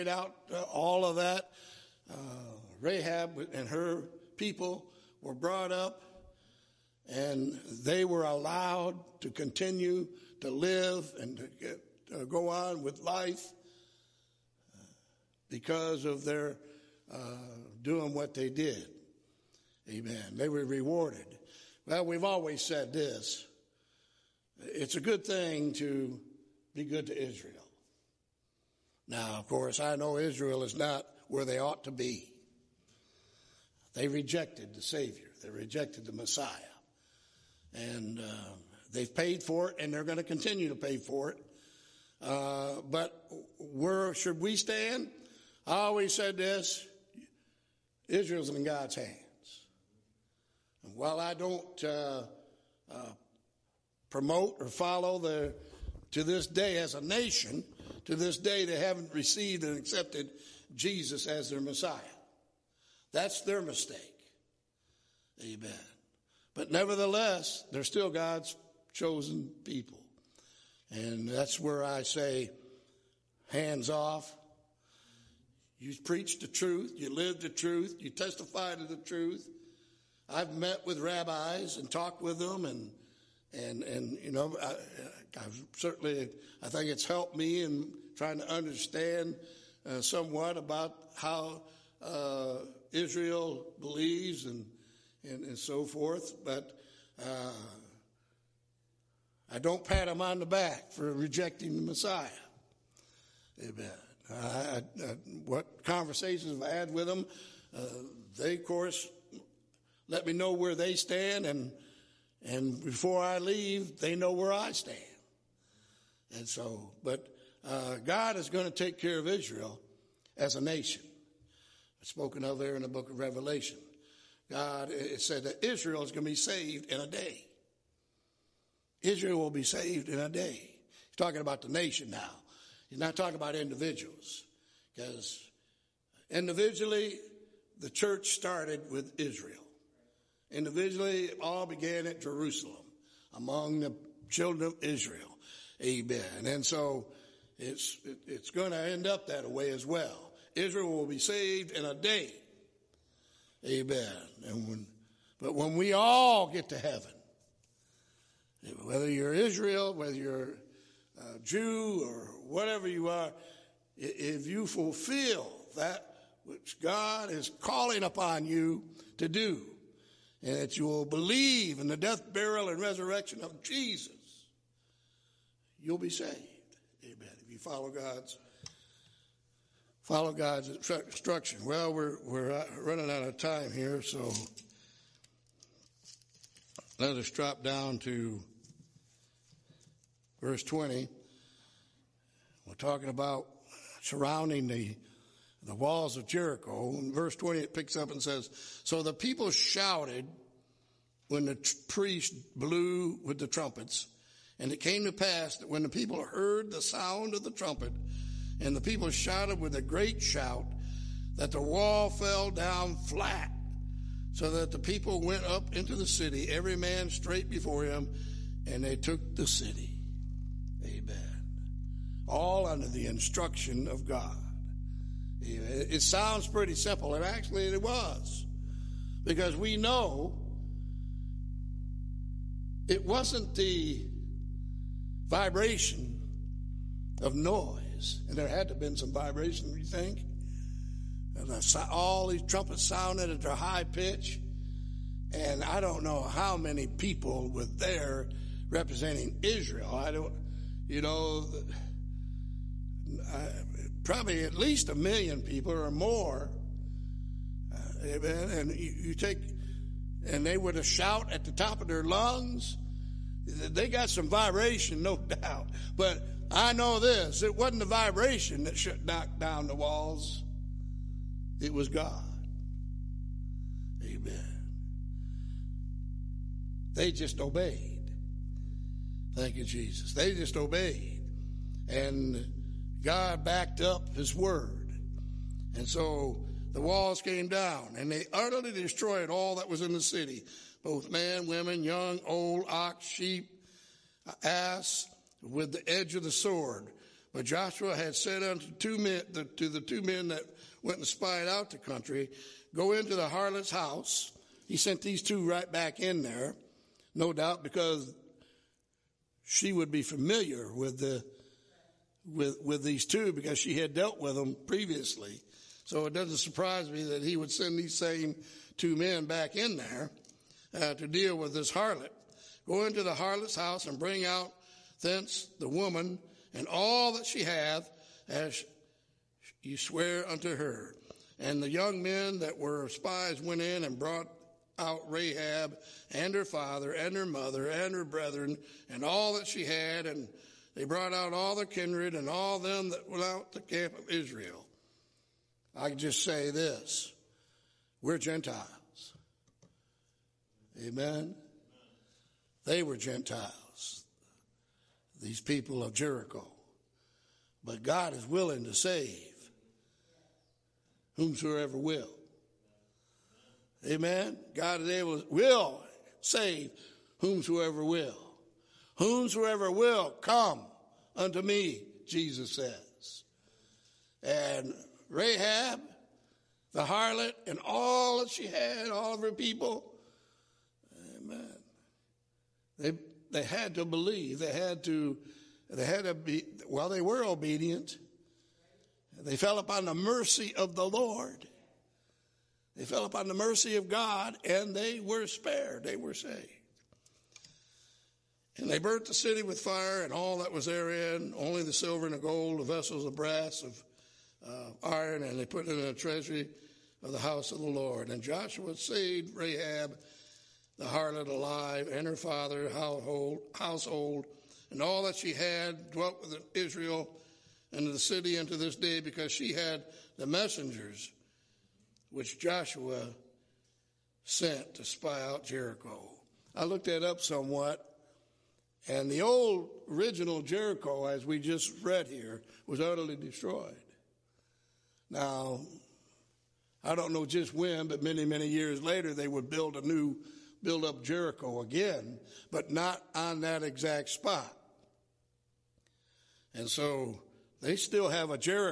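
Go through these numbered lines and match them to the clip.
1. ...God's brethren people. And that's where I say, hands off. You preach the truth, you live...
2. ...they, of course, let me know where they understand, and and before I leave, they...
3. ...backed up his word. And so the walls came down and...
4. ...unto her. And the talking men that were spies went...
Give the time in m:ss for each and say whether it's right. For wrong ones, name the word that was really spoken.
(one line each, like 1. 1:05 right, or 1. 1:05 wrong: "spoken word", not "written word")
1. 1:08 wrong: "chosen", not "brethren"
2. 1:48 wrong: "stand", not "understand"
3. 4:43 right
4. 5:30 wrong: "young", not "talking".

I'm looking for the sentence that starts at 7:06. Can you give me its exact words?
I looked that up somewhat and the old original Jericho, as we just read here, was utterly destroyed.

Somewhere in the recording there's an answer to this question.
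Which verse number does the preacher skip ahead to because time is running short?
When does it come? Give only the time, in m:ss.
3:10.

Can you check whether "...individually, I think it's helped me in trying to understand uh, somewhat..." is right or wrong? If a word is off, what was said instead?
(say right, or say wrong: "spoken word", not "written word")
wrong: "certainly", not "individually".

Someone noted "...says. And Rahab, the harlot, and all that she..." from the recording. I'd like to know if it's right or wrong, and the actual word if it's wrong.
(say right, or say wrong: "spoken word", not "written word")
right.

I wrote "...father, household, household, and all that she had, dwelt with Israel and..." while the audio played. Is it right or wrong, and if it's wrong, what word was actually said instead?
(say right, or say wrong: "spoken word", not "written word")
right.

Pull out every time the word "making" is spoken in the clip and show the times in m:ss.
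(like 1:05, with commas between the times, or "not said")
not said.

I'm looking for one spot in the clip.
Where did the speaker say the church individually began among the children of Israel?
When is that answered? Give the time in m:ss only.
2:22.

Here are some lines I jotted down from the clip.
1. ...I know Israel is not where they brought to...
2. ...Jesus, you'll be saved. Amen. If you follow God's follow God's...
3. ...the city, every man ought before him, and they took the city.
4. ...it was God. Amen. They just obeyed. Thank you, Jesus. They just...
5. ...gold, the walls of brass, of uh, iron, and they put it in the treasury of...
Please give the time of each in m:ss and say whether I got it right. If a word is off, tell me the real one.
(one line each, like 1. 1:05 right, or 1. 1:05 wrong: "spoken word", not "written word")
1. 0:29 wrong: "ought", not "brought"
2. 2:53 right
3. 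3:35 wrong: "straight", not "ought"
4. 4:31 right
5. 6:42 wrong: "vessels", not "walls".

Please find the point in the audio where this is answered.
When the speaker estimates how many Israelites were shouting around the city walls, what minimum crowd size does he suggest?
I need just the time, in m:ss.
4:14.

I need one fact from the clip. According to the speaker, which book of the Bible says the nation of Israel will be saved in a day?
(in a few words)
Revelation.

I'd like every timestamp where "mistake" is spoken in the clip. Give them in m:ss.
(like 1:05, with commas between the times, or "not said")
1:03.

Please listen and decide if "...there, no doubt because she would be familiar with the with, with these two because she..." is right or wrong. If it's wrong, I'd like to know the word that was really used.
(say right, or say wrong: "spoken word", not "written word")
right.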